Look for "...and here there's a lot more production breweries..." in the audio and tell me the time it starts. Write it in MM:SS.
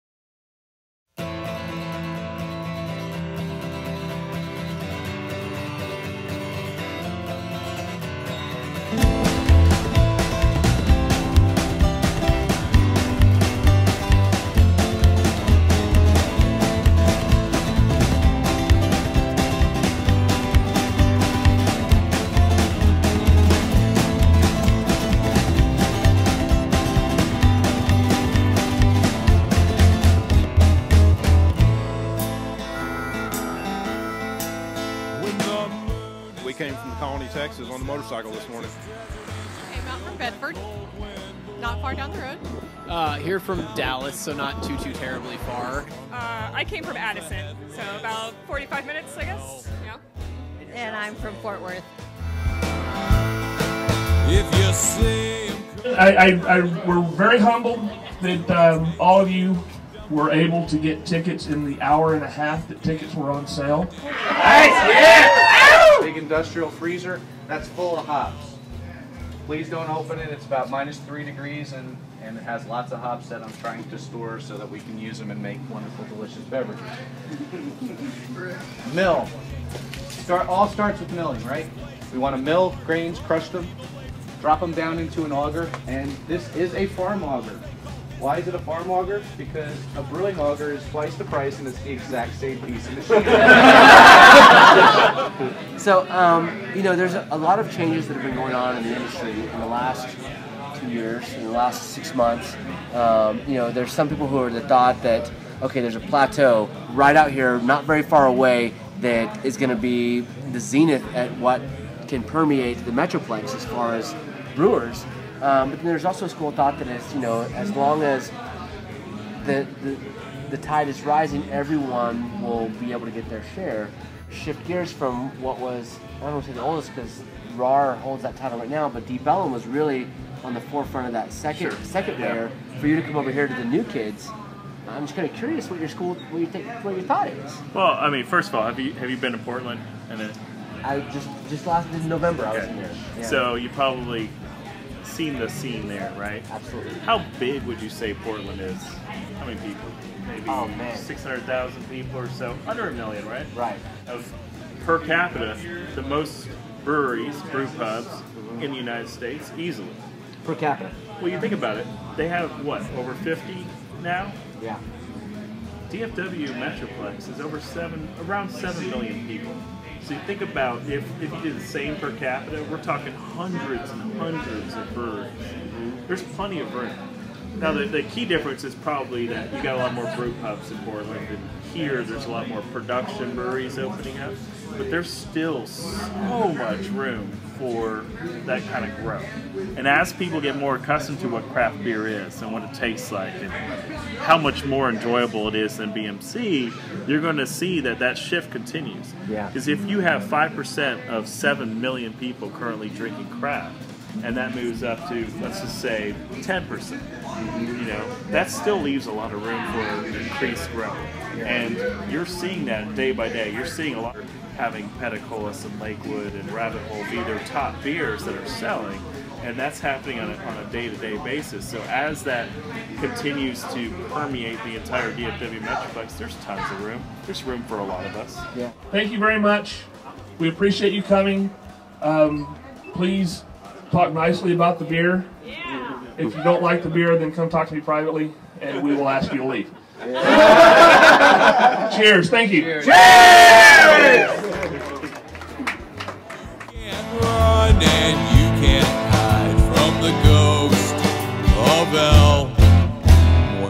03:01.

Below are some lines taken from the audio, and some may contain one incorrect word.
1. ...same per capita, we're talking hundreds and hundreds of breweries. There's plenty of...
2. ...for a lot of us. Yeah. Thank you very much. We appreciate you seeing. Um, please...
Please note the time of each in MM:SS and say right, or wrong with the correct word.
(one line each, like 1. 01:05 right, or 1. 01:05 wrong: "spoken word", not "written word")
1. 02:51 right
2. 03:47 wrong: "coming", not "seeing".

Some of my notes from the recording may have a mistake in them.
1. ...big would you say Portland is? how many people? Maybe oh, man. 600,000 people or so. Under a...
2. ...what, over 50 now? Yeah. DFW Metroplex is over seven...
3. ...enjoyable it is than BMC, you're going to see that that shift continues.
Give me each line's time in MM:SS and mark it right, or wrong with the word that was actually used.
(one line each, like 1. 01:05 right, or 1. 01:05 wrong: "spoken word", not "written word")
1. 02:27 right
2. 02:42 right
3. 03:14 right.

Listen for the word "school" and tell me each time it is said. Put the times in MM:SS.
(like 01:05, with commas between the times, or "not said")
01:56, 02:15.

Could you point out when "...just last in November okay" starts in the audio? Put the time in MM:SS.
02:21.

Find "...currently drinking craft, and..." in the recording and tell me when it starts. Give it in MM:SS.
03:22.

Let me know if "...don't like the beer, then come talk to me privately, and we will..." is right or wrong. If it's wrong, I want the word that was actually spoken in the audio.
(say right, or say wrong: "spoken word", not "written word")
right.